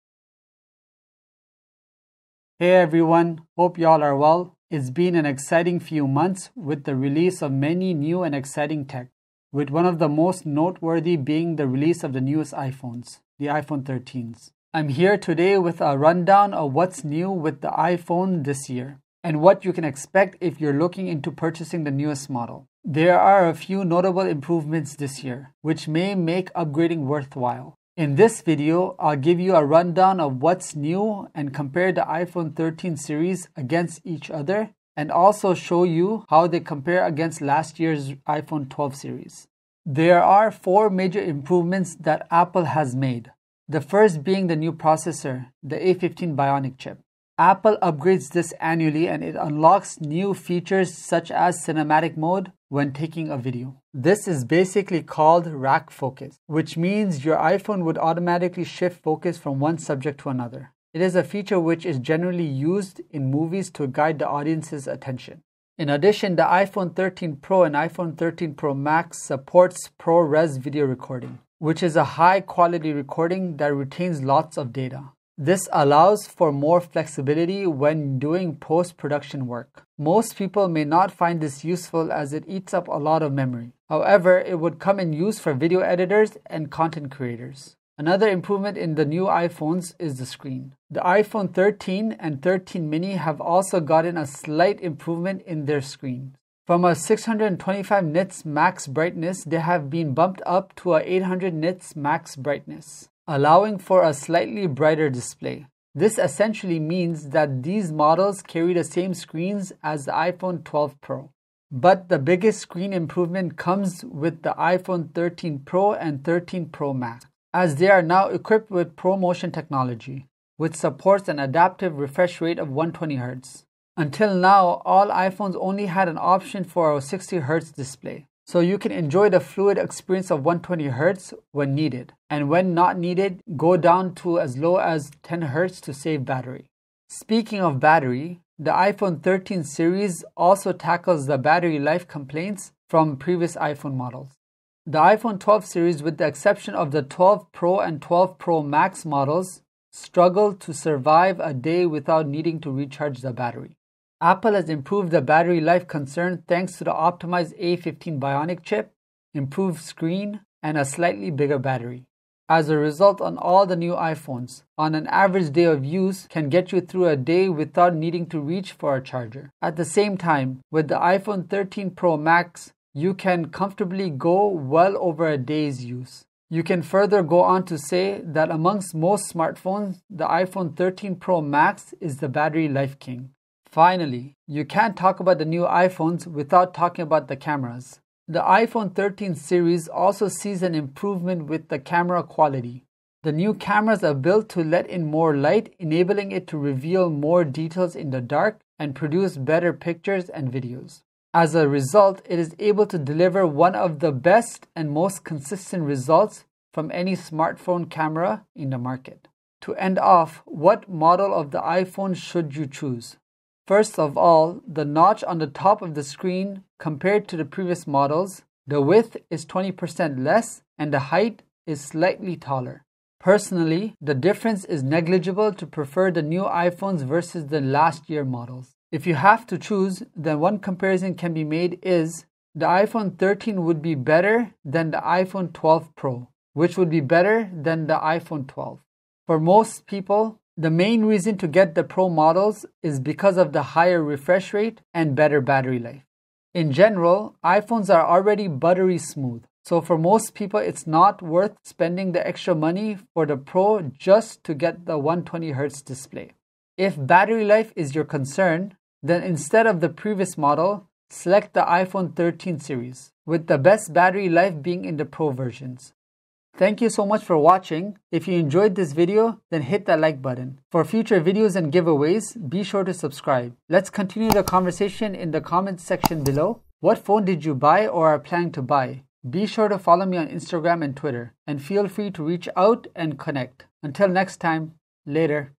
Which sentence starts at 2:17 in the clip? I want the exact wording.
Speaking of battery, the iPhone 13 series also tackles the battery life complaints from previous iPhone models.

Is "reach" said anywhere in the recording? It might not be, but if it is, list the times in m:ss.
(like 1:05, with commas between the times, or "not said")
2:48, 4:42.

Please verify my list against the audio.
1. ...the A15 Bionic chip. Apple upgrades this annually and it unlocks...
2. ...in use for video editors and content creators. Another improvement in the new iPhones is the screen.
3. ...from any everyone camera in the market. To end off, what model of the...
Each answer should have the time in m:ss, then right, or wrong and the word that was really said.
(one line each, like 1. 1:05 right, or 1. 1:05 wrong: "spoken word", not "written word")
1. 0:45 right
2. 1:24 right
3. 3:26 wrong: "smartphone", not "everyone".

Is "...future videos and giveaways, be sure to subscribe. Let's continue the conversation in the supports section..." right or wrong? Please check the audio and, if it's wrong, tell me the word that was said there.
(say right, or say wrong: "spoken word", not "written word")
wrong: "comments", not "supports".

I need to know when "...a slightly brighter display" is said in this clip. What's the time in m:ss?
1:44.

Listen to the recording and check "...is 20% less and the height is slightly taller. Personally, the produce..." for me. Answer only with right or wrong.
wrong.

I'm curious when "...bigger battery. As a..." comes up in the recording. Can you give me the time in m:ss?
2:41.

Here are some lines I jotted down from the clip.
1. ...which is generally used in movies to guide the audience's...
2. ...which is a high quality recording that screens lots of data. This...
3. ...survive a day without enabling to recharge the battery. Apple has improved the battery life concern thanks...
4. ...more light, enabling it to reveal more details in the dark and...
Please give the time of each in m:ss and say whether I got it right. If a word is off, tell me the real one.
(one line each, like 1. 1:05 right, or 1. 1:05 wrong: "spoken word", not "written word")
1. 1:01 right
2. 1:11 wrong: "retains", not "screens"
3. 2:30 wrong: "needing", not "enabling"
4. 3:15 right.